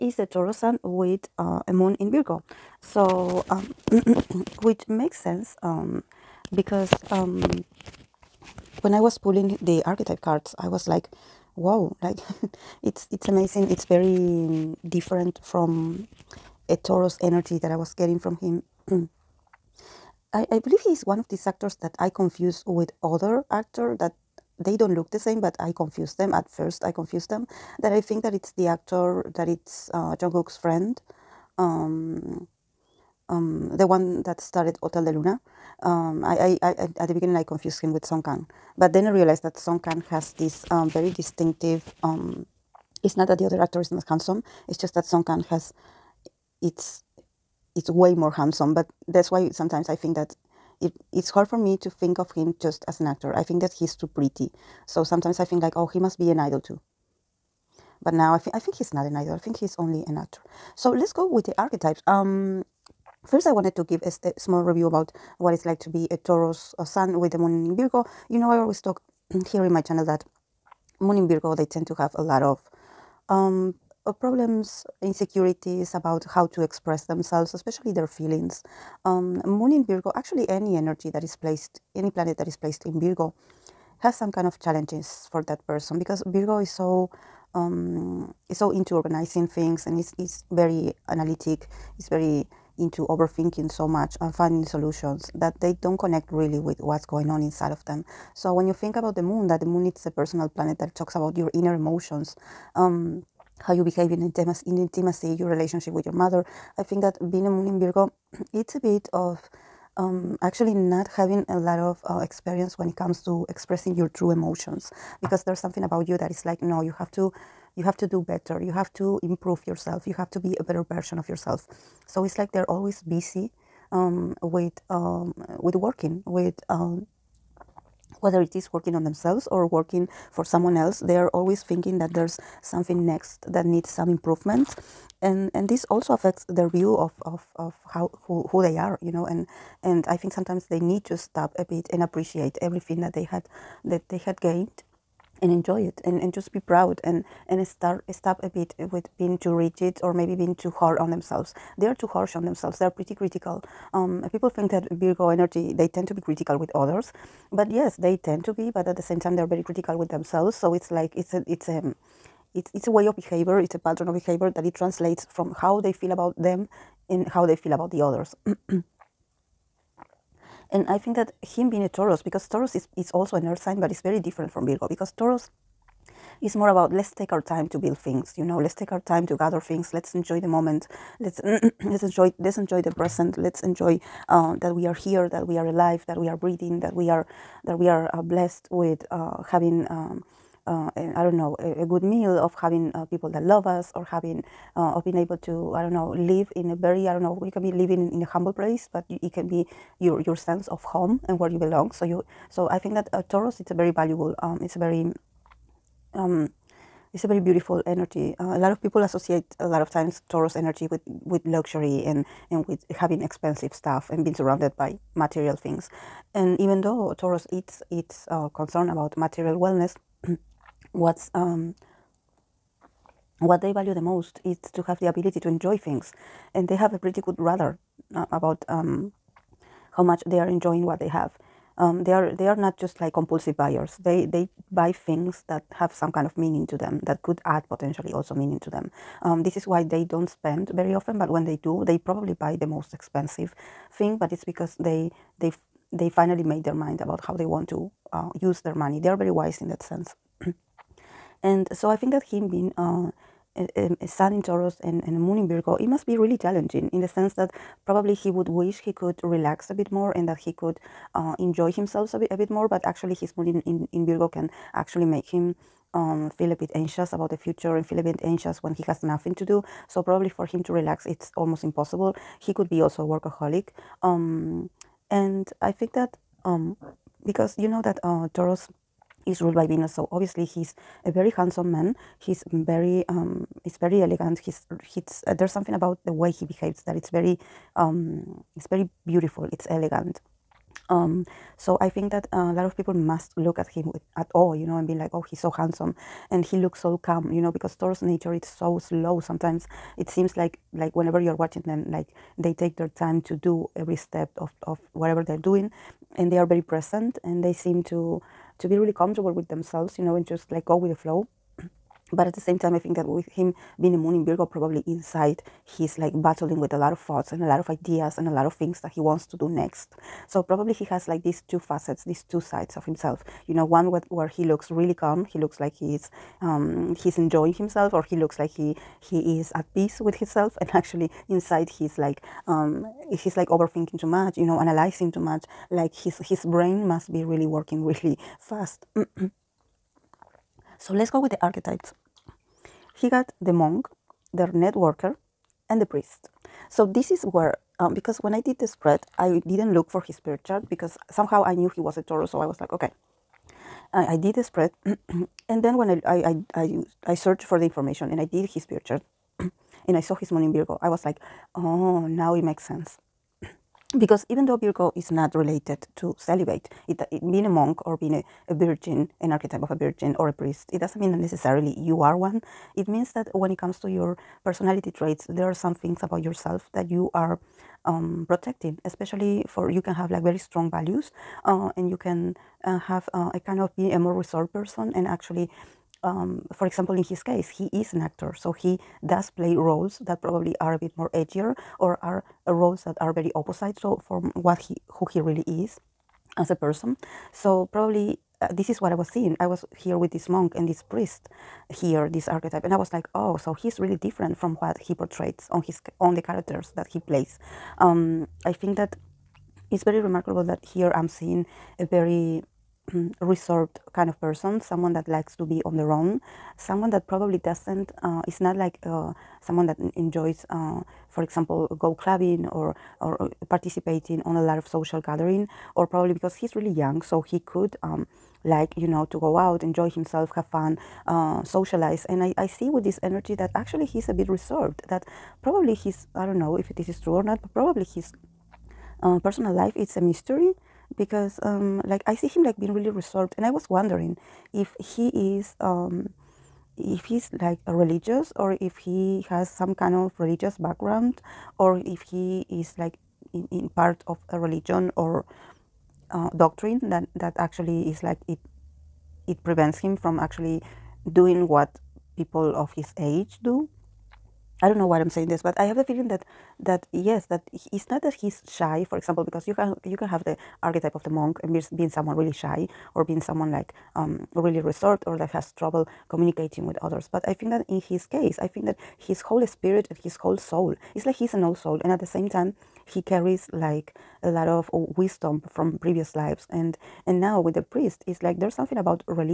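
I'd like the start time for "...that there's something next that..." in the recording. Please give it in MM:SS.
02:11.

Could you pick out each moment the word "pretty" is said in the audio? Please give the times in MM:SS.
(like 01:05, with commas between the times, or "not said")
00:54, 02:32, 03:46.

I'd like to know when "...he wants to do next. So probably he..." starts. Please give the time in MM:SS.
05:18.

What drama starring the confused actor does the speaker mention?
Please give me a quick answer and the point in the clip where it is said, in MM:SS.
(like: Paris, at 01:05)
Hotel de Luna, at 00:34.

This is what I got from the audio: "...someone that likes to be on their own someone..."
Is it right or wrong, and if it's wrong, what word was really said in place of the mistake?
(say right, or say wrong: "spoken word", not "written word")
right.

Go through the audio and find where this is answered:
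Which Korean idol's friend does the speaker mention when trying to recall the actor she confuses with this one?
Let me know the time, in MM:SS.
00:30.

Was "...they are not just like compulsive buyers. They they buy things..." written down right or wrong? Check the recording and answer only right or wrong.
right.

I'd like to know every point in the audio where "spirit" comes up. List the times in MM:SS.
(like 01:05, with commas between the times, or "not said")
05:50, 05:58, 07:59.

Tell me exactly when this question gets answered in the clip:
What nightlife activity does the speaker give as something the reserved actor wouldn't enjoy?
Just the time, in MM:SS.
07:01.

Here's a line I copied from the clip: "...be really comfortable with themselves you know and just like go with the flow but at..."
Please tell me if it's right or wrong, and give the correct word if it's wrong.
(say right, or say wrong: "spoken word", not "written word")
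right.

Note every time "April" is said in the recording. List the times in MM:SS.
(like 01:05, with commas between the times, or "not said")
not said.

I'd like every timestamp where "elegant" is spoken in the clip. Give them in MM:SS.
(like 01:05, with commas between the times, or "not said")
04:44, 04:49.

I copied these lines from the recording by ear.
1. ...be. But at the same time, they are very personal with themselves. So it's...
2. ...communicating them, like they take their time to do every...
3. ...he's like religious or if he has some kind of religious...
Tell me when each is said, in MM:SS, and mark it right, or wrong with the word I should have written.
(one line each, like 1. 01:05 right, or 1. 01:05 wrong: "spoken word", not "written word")
1. 02:38 wrong: "critical", not "personal"
2. 05:01 wrong: "watching", not "communicating"
3. 07:27 right.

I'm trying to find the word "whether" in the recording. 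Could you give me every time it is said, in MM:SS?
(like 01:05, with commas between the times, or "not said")
02:08.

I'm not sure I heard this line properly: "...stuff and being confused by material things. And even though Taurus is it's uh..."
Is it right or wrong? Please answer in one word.
wrong.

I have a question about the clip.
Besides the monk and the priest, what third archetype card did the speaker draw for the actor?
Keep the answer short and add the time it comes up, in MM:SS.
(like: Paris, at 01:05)
the networker, at 05:44.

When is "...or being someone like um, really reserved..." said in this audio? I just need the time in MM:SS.
07:52.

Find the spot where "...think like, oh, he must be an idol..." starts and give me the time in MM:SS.
00:55.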